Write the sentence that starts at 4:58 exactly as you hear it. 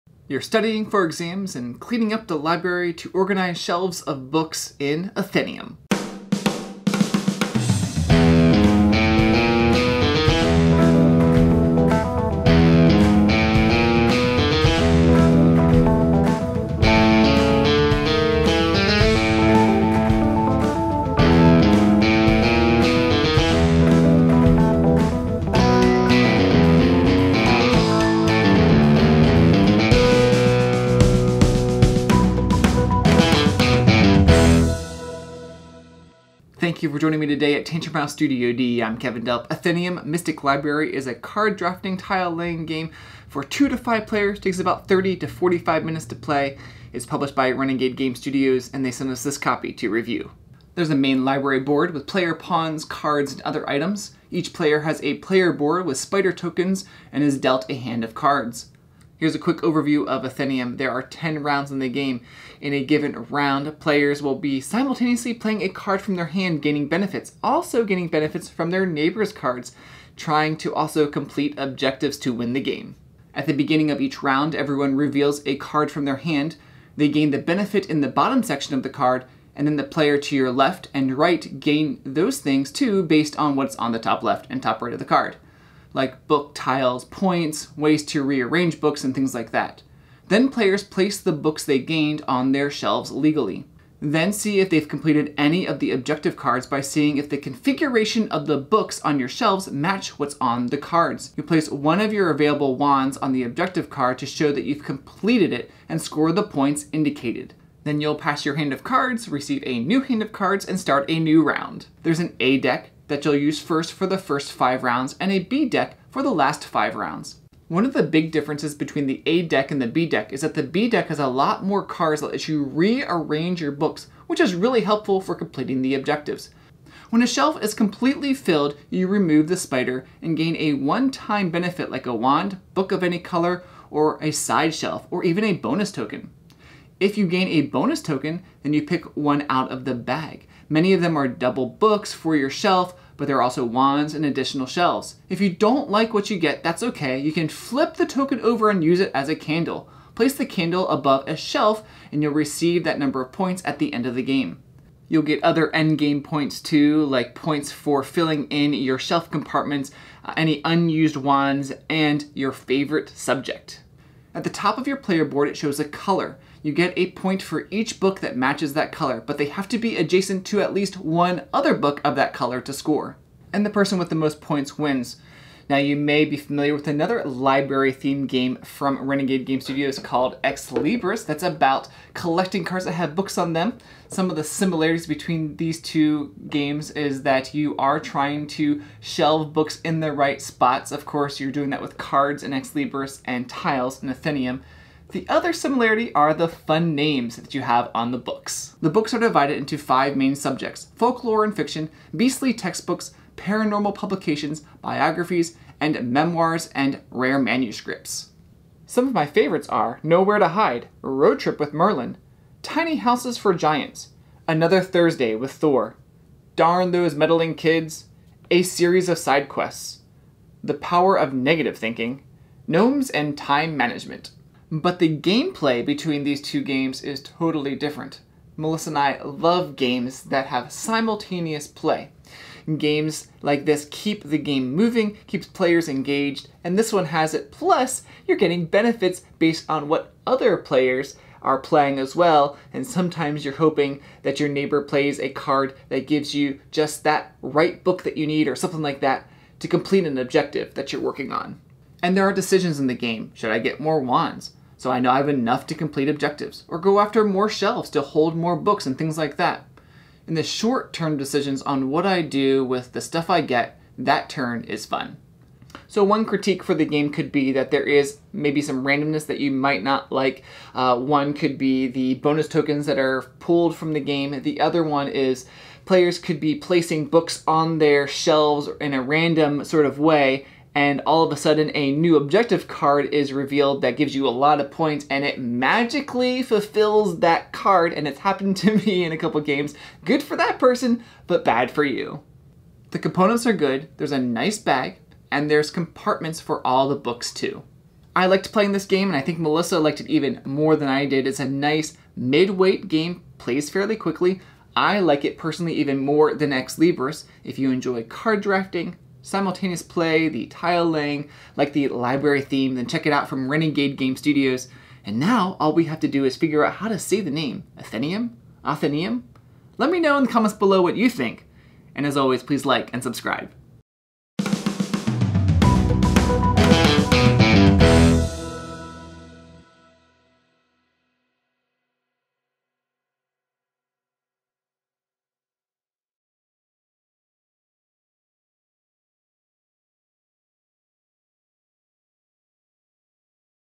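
I liked playing this game and I think Melissa liked it even more than I did.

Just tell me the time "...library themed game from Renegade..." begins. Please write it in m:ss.
2:57.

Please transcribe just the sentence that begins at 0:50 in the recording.
There's a main library board with player pawns, cards, and other items.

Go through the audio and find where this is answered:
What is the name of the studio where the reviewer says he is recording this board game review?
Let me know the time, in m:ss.
0:37.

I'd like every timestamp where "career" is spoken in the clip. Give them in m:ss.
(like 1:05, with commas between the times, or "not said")
not said.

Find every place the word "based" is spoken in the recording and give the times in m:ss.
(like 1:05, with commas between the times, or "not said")
1:23, 3:59.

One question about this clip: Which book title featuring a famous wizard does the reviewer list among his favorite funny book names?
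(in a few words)
Road Trip with Merlin.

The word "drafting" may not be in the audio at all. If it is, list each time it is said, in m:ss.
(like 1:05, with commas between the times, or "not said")
0:41, 5:08.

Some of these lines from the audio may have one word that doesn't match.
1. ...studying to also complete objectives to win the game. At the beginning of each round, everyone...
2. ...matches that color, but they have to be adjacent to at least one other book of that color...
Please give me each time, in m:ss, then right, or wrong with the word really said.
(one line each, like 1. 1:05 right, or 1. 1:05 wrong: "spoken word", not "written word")
1. 1:10 wrong: "trying", not "studying"
2. 2:48 right.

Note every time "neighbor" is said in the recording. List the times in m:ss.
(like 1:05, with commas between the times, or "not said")
1:08, 4:04.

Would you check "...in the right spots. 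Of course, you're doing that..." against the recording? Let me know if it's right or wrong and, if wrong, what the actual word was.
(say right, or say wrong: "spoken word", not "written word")
right.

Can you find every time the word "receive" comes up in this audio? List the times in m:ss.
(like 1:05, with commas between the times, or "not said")
1:49, 2:32.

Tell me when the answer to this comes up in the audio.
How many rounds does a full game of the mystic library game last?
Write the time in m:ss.
1:01.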